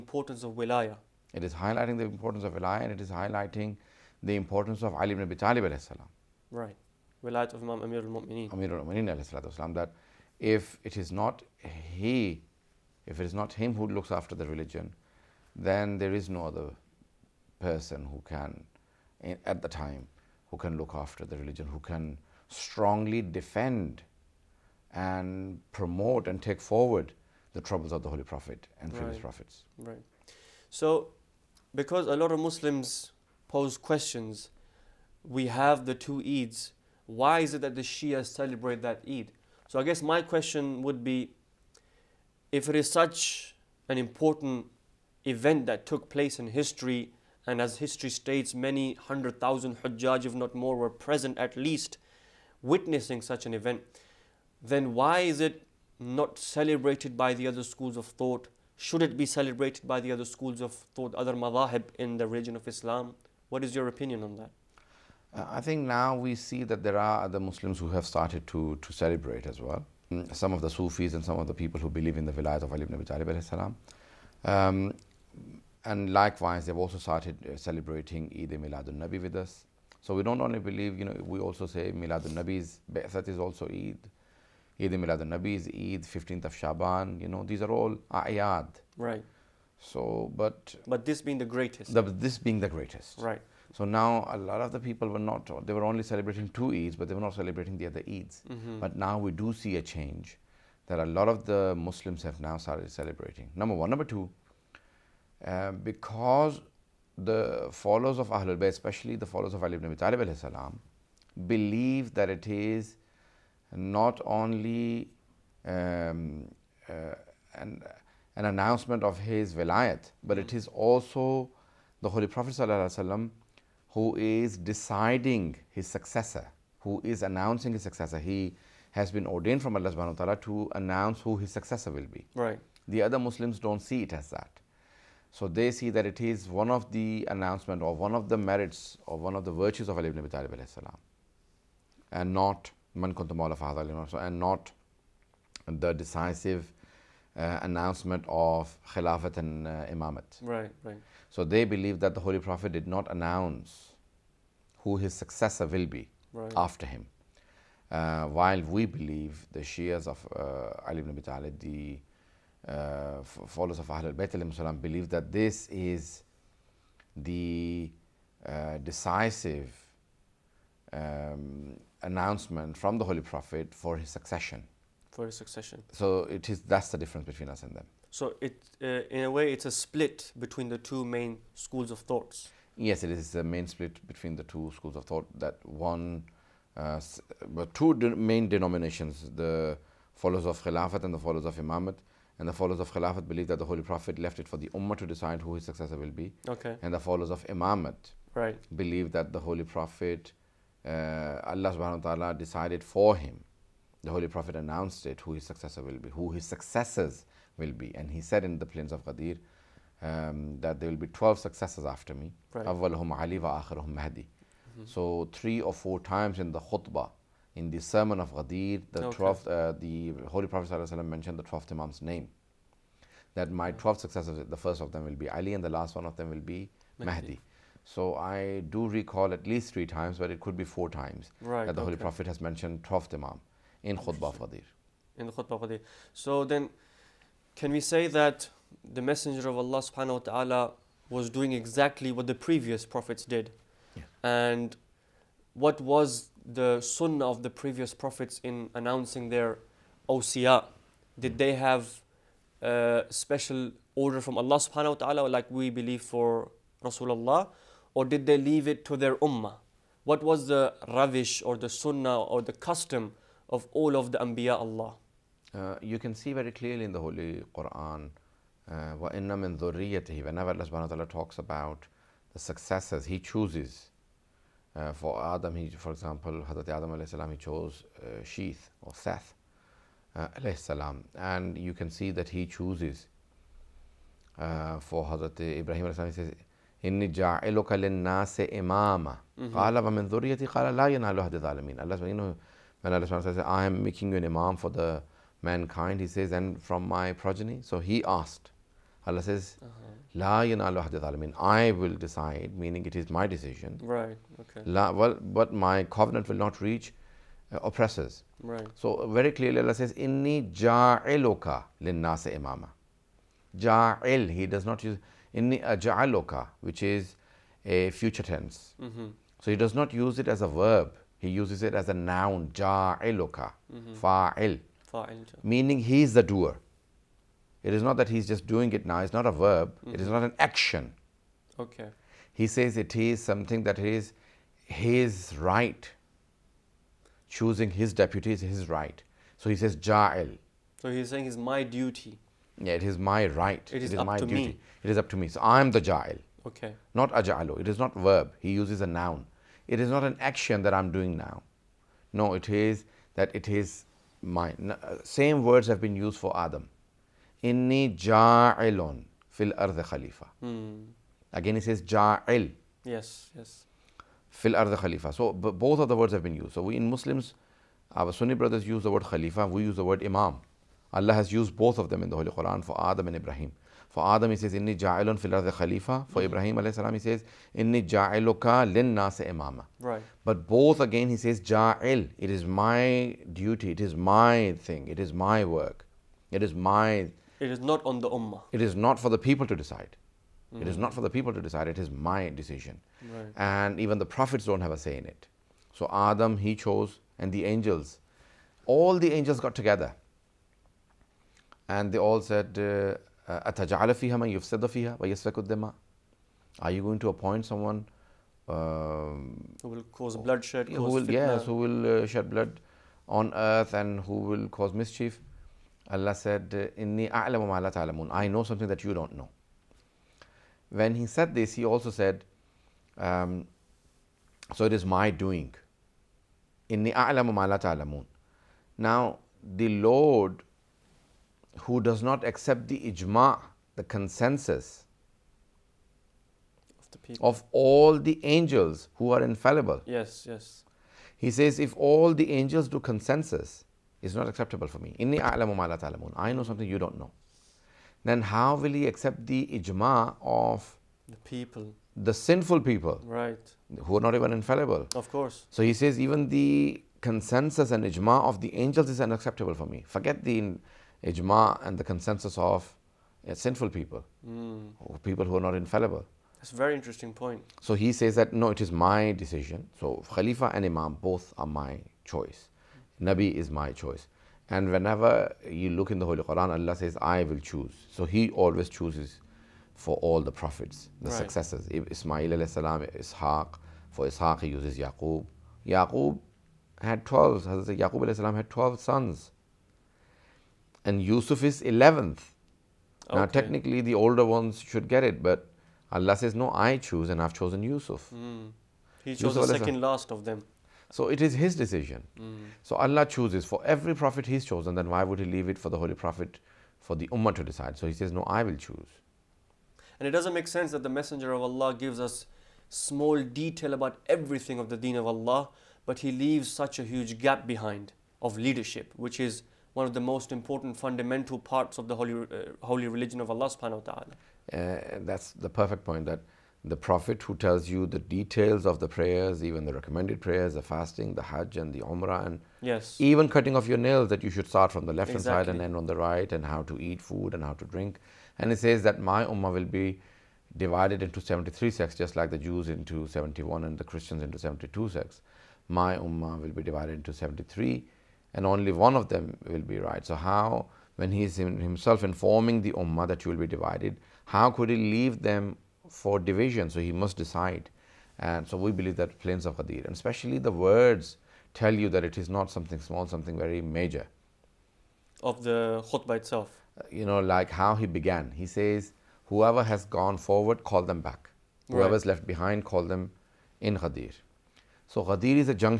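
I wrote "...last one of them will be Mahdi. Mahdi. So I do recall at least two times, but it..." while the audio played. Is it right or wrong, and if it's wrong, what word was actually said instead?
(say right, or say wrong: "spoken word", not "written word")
wrong: "three", not "two".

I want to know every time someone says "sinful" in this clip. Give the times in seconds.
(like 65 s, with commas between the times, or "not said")
452 s, 463 s.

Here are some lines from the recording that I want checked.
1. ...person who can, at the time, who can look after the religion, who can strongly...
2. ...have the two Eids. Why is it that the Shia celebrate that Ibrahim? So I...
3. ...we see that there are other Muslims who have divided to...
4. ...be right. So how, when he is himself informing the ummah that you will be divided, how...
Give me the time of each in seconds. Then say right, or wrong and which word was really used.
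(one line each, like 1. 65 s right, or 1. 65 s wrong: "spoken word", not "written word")
1. 17 s right
2. 35 s wrong: "Eid", not "Ibrahim"
3. 66 s wrong: "started", not "divided"
4. 549 s right.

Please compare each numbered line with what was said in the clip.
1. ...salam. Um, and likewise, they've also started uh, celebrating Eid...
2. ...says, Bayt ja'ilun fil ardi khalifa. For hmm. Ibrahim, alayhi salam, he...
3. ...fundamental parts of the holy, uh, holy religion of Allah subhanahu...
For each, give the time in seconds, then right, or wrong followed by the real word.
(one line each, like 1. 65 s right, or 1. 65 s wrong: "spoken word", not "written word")
1. 73 s right
2. 374 s wrong: "Inni", not "Bayt"
3. 520 s right.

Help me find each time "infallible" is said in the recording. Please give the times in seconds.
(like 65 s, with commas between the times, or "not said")
439 s, 454 s, 465 s.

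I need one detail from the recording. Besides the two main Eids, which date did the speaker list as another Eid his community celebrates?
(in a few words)
15th of Shaban.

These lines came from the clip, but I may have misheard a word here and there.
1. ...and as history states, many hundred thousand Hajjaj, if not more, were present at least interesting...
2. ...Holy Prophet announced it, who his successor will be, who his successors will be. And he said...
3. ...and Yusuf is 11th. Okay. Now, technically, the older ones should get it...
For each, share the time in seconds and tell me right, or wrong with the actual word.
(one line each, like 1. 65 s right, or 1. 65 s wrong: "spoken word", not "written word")
1. 47 s wrong: "witnessing", not "interesting"
2. 204 s right
3. 490 s right.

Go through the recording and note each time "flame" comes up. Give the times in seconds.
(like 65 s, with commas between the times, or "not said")
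not said.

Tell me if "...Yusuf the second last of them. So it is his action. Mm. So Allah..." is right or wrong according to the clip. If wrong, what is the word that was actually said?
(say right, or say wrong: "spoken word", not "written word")
wrong: "decision", not "action".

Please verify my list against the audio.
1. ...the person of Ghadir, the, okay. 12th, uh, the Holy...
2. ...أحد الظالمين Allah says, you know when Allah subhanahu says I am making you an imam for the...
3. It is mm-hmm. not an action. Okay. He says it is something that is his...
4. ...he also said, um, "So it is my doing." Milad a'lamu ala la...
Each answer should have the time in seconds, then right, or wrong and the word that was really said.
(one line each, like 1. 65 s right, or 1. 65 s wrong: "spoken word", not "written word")
1. 217 s wrong: "sermon", not "person"
2. 291 s right
3. 329 s right
4. 421 s wrong: "Inni", not "Milad".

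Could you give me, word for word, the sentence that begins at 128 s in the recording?
He has been ordained from Allah subhanahu wa ta'ala to announce who his successor will be.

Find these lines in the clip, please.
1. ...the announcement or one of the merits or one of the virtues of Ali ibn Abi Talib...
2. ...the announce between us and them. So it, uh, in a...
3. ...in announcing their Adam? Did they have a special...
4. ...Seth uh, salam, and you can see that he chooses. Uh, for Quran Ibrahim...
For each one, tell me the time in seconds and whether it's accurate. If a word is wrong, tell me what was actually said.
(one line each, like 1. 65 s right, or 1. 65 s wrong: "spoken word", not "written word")
1. 136 s right
2. 176 s wrong: "difference", not "announce"
3. 248 s wrong: "OCR", not "Adam"
4. 278 s wrong: "Hazrat", not "Quran".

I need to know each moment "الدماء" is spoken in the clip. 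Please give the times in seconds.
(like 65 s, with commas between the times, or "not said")
405 s.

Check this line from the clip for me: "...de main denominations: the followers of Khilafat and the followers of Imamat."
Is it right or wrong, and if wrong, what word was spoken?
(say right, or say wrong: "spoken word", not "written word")
right.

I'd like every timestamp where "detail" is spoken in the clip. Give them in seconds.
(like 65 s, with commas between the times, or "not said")
513 s, 527 s.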